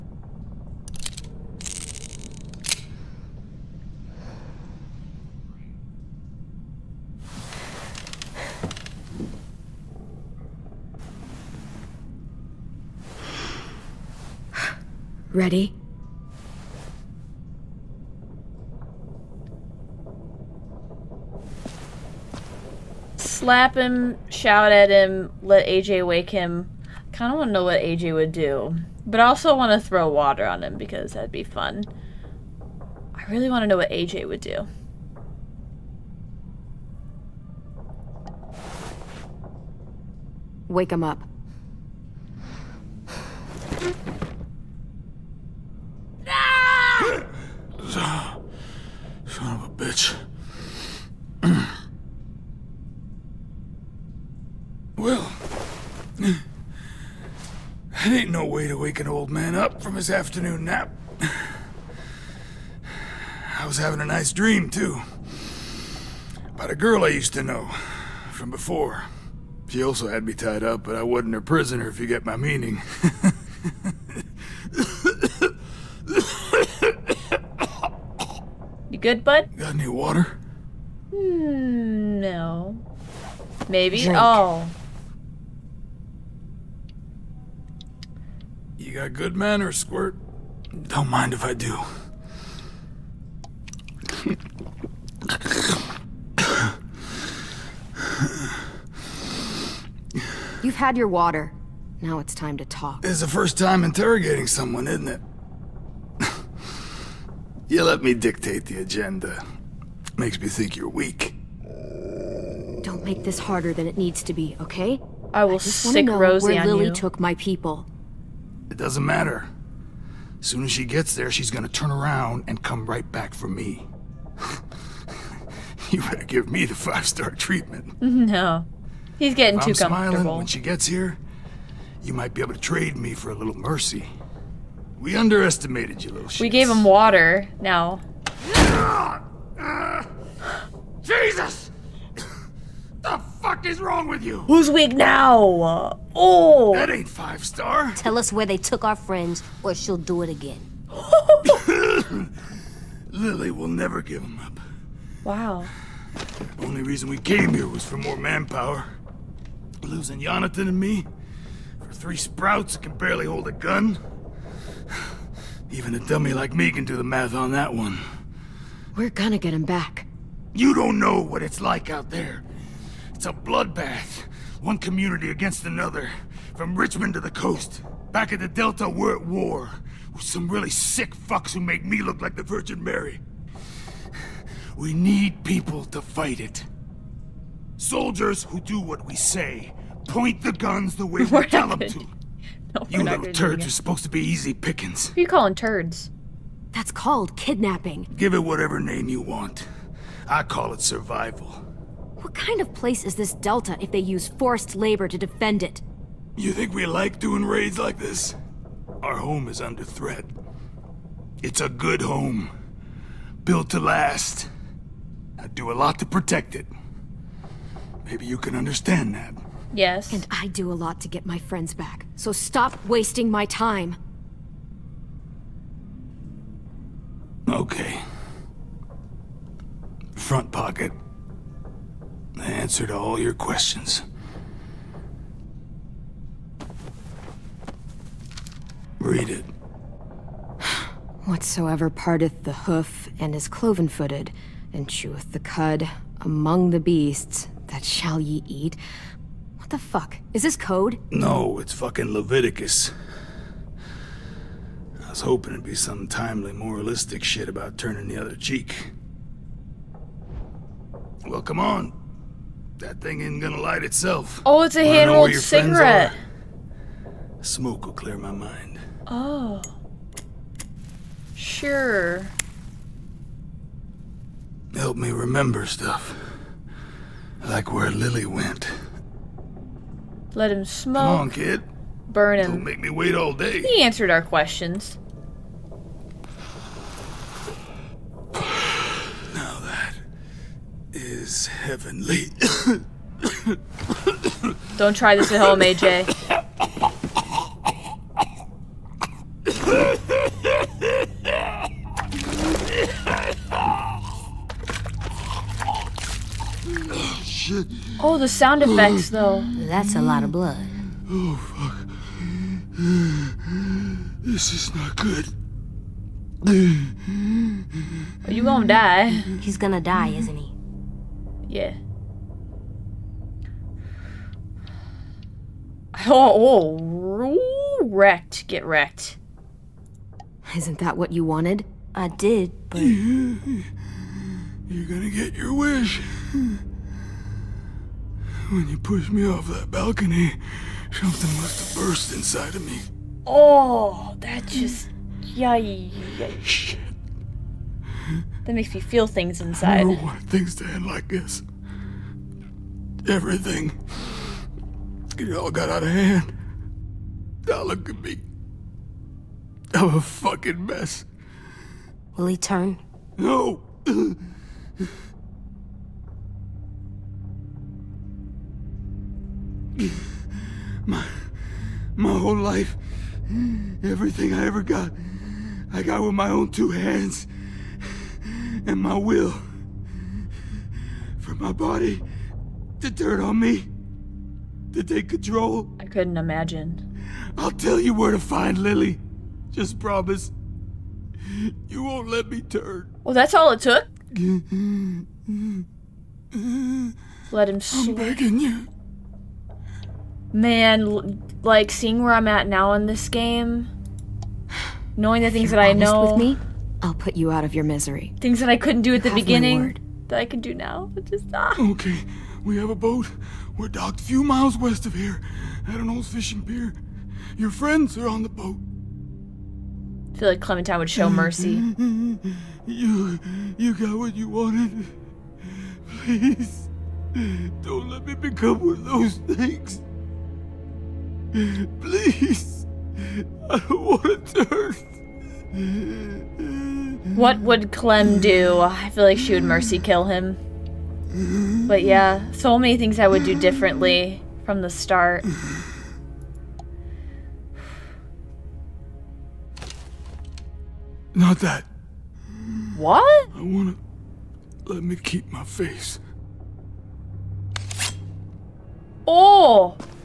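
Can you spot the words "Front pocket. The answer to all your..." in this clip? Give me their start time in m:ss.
3:50.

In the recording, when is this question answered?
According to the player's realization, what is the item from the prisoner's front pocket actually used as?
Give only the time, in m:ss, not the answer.
4:24.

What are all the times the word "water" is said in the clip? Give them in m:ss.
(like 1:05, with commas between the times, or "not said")
0:30, 1:19, 1:41, 2:16.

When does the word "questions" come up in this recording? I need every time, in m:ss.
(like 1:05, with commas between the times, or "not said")
3:53, 4:44.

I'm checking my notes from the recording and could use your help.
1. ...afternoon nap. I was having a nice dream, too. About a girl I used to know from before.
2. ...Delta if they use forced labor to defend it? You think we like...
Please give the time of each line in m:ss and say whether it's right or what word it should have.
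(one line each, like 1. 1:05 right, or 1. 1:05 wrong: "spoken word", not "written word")
1. 1:00 right
2. 3:23 right.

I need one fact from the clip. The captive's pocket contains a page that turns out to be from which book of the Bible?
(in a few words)
Leviticus.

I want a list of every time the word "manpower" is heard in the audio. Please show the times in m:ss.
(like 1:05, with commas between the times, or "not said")
2:38.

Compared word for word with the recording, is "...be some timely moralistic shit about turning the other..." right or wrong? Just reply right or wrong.
right.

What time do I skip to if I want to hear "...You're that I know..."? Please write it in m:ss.
6:45.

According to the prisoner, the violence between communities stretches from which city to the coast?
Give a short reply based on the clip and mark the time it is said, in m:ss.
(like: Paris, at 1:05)
Richmond, at 2:56.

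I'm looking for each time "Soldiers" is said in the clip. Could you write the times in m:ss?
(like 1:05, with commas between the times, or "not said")
3:07.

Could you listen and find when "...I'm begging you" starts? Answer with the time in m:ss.
6:37.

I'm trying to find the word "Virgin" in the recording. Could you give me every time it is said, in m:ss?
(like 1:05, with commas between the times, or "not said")
3:02.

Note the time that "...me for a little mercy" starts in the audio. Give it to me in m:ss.
2:12.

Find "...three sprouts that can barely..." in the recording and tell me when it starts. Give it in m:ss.
2:41.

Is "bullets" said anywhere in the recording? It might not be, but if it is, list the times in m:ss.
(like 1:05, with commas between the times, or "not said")
not said.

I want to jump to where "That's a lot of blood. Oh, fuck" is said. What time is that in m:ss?
5:09.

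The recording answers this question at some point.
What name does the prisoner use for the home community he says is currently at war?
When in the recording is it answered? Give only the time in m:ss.
2:58.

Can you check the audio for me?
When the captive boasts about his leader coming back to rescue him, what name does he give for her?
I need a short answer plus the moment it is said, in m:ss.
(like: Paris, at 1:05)
Rosie, at 1:56.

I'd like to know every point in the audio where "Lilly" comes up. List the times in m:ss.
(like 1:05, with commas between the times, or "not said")
1:56, 2:33, 4:37.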